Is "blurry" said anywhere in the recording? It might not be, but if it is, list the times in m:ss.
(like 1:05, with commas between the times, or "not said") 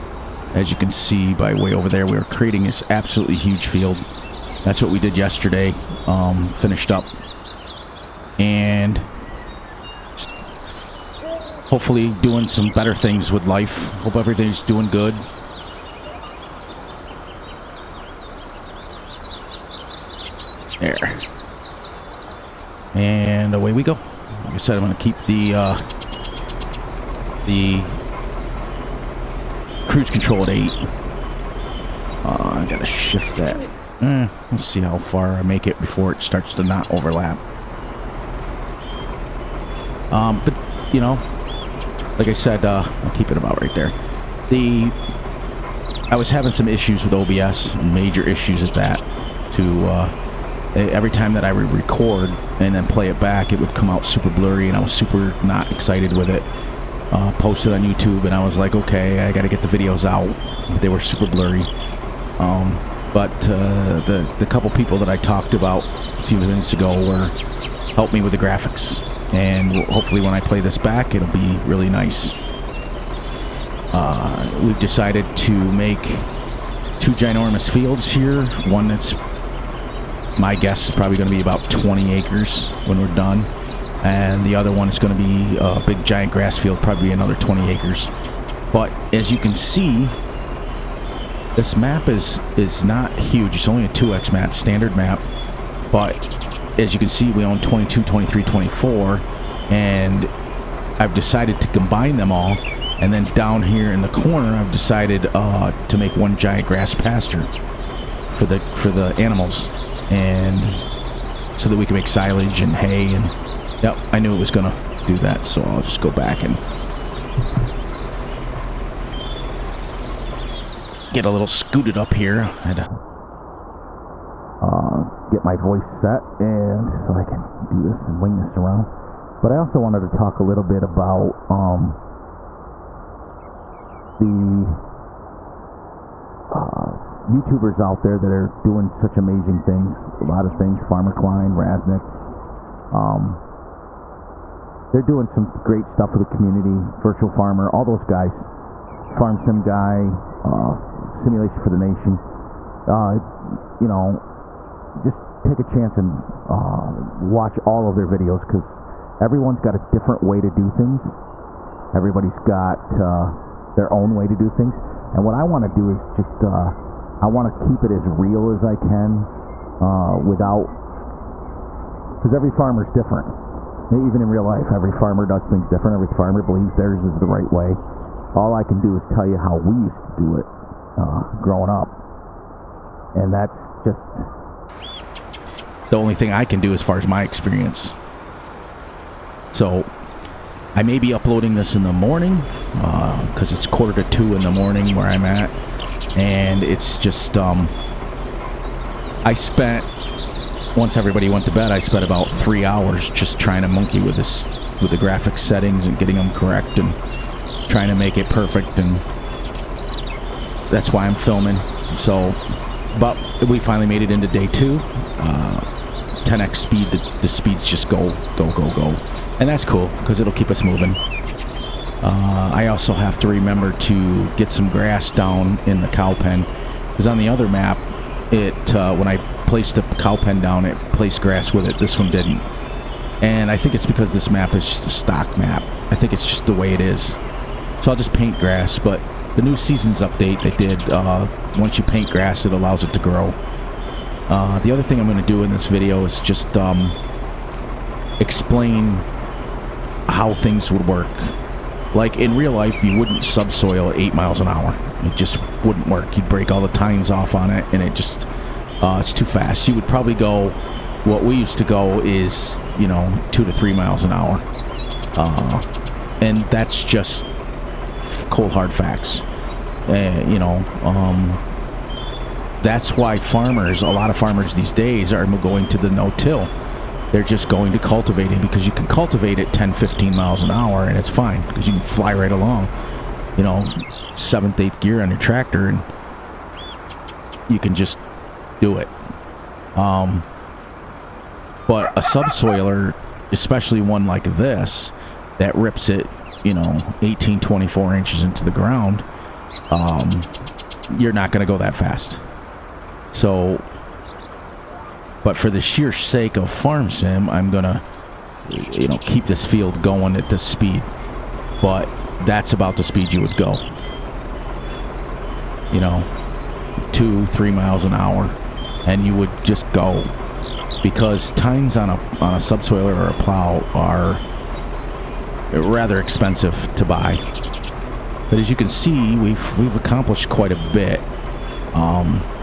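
0:54, 1:01.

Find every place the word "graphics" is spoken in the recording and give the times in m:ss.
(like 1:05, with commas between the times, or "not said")
1:08, 3:24.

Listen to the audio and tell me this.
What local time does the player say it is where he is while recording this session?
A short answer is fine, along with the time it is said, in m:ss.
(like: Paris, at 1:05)
Quarter to two, at 3:13.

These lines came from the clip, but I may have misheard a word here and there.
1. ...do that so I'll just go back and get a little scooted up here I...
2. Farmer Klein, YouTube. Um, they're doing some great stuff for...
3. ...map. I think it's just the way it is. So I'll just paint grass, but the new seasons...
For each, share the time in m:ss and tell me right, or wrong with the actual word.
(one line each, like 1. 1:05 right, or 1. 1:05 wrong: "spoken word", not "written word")
1. 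1:55 right
2. 2:20 wrong: "Raznik", not "YouTube"
3. 3:55 right.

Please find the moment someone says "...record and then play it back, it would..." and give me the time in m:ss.
0:51.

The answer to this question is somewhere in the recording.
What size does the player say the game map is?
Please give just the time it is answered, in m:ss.
1:33.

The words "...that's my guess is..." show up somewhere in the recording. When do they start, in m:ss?
1:18.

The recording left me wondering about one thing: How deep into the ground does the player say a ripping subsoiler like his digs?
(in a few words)
18 to 24 inches.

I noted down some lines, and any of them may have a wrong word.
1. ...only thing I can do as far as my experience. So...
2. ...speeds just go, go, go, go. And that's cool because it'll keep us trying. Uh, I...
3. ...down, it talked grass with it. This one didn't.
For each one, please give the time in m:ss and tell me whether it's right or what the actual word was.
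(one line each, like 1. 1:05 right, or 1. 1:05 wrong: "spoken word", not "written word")
1. 3:05 right
2. 3:37 wrong: "moving", not "trying"
3. 3:50 wrong: "placed", not "talked".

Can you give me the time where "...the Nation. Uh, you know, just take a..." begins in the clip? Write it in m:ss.
2:31.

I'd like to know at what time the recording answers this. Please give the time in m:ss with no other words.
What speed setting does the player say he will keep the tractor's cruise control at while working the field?
0:30.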